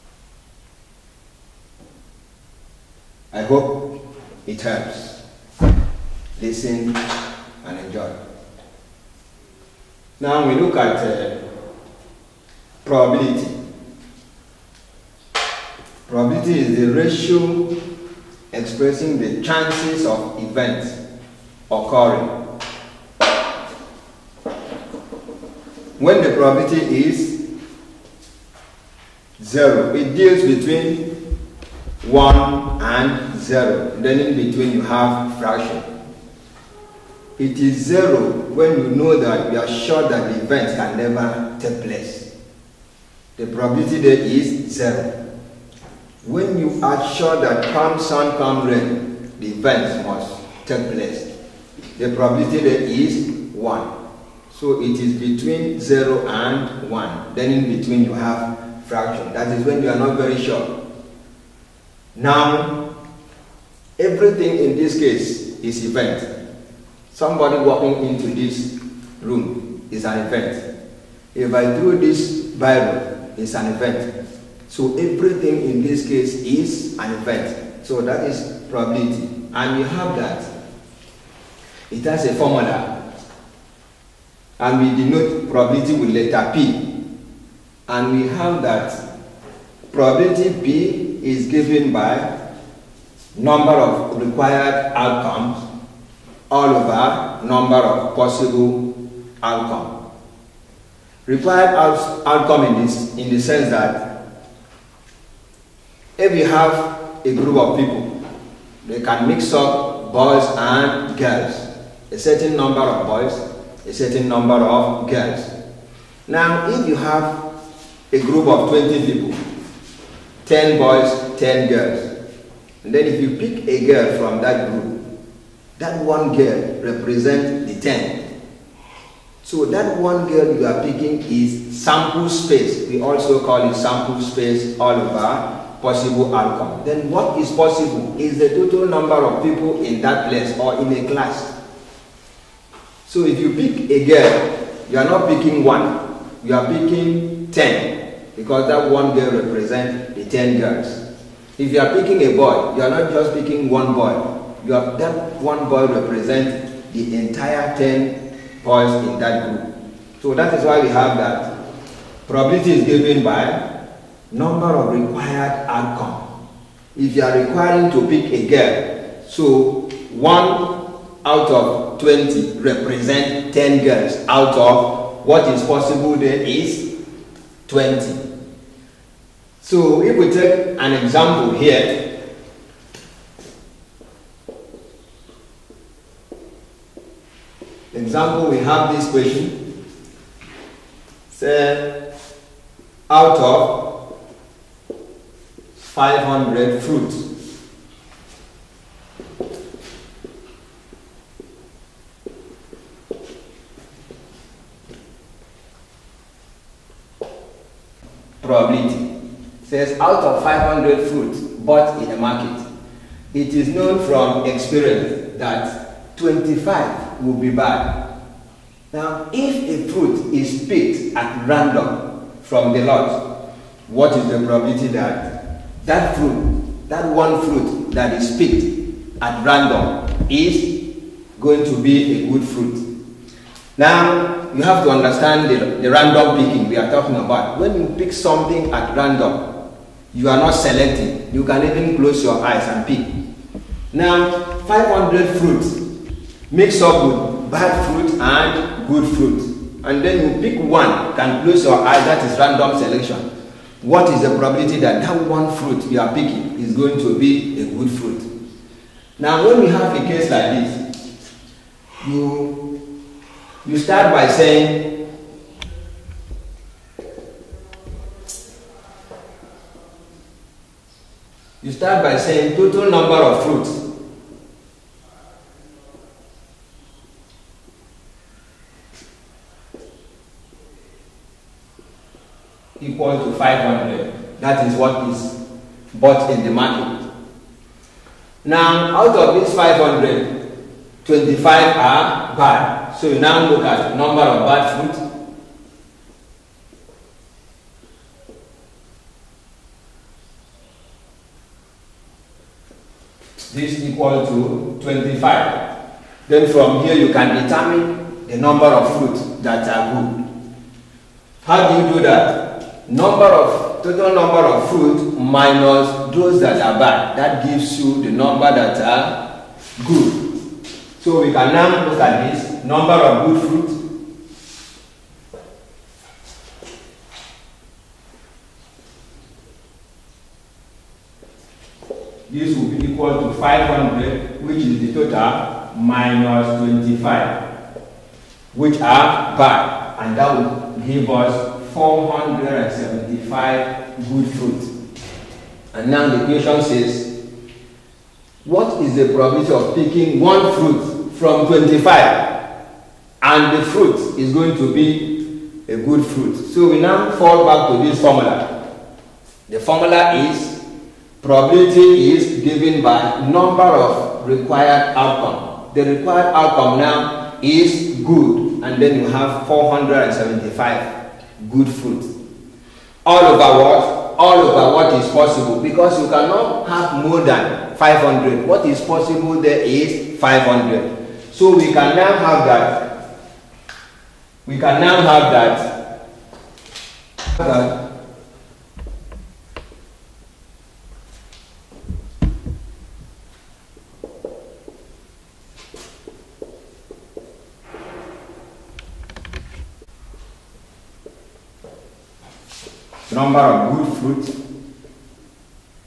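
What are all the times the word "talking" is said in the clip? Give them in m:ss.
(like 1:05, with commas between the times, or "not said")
3:56.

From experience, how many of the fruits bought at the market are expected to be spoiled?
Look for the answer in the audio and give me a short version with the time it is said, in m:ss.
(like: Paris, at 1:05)
25, at 3:36.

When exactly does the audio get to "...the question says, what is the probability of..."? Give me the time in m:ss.
5:46.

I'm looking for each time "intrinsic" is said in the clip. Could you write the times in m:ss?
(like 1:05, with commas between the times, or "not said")
not said.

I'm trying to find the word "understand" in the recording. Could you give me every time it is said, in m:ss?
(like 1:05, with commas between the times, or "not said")
3:54.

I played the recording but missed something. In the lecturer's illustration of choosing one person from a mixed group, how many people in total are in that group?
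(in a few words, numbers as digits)
20.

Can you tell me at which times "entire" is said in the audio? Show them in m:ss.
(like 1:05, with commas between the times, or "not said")
2:37.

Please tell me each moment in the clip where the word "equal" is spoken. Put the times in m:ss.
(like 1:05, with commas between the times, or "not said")
5:03, 5:32.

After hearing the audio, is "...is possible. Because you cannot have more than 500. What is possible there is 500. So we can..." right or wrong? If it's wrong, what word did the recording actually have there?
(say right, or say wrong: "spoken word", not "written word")
right.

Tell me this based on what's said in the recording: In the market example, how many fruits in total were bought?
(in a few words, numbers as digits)
500.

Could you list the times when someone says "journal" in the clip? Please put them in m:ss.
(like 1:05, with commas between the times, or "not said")
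not said.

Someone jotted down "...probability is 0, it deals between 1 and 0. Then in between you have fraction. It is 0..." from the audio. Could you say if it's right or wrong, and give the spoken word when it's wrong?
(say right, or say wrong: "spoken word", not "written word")
right.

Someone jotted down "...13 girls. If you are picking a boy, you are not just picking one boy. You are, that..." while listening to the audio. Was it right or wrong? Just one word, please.
wrong.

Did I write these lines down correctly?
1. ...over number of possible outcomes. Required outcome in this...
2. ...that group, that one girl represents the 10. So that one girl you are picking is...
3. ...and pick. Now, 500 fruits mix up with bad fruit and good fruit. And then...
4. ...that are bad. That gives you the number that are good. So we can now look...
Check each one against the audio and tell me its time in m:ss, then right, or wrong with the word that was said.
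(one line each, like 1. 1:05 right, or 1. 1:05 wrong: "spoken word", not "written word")
1. 1:36 right
2. 2:04 right
3. 4:02 right
4. 5:16 right.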